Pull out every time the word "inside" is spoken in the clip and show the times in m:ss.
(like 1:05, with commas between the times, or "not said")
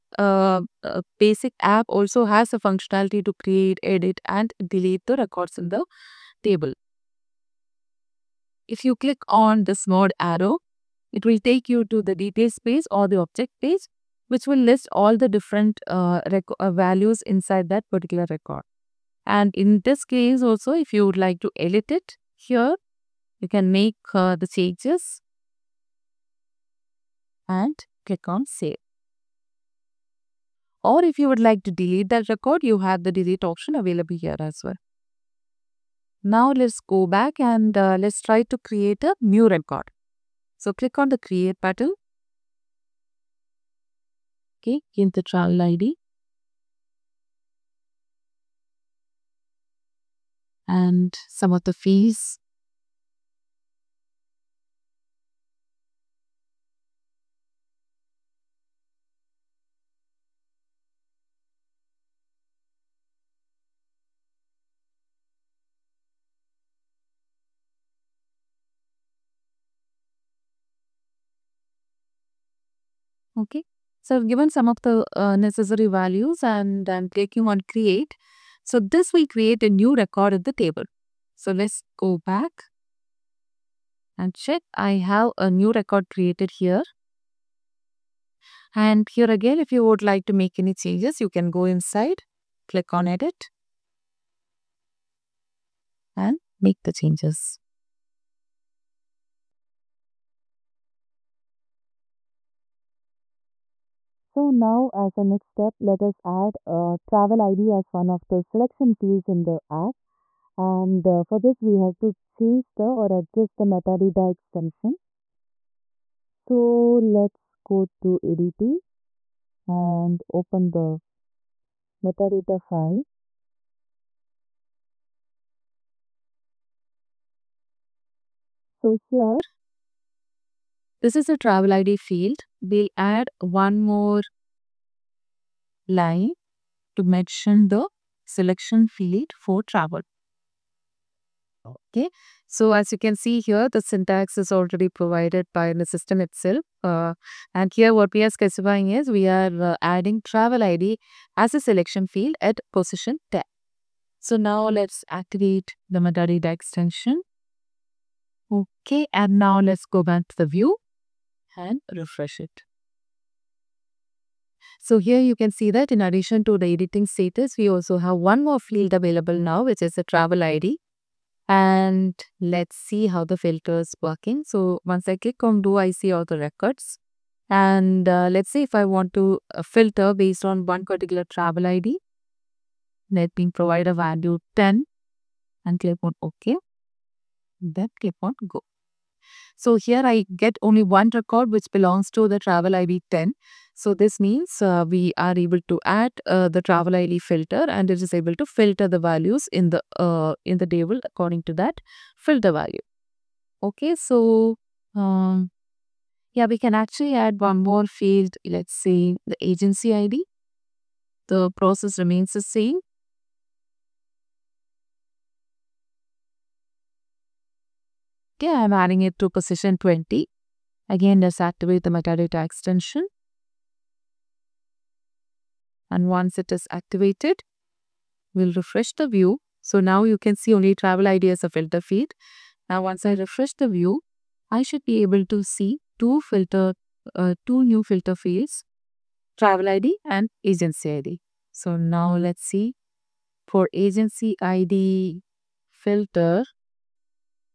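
0:17, 1:31.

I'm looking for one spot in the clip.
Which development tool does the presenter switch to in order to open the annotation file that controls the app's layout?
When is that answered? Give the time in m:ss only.
1:58.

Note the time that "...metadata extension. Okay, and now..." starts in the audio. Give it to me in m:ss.
2:35.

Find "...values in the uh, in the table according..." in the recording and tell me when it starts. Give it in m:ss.
3:18.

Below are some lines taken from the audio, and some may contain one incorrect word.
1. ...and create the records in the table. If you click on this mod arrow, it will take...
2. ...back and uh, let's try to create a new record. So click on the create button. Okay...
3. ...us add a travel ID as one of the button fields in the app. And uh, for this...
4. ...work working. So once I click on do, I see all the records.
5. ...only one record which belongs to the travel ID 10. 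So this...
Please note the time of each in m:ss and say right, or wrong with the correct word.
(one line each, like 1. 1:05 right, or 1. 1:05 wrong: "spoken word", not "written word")
1. 0:04 wrong: "delete", not "create"
2. 0:37 right
3. 1:46 wrong: "selection", not "button"
4. 2:54 right
5. 3:10 right.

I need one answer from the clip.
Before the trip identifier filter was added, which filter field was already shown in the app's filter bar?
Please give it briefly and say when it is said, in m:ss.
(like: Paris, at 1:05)
editing status, at 2:46.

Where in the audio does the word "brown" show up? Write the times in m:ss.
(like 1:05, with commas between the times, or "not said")
not said.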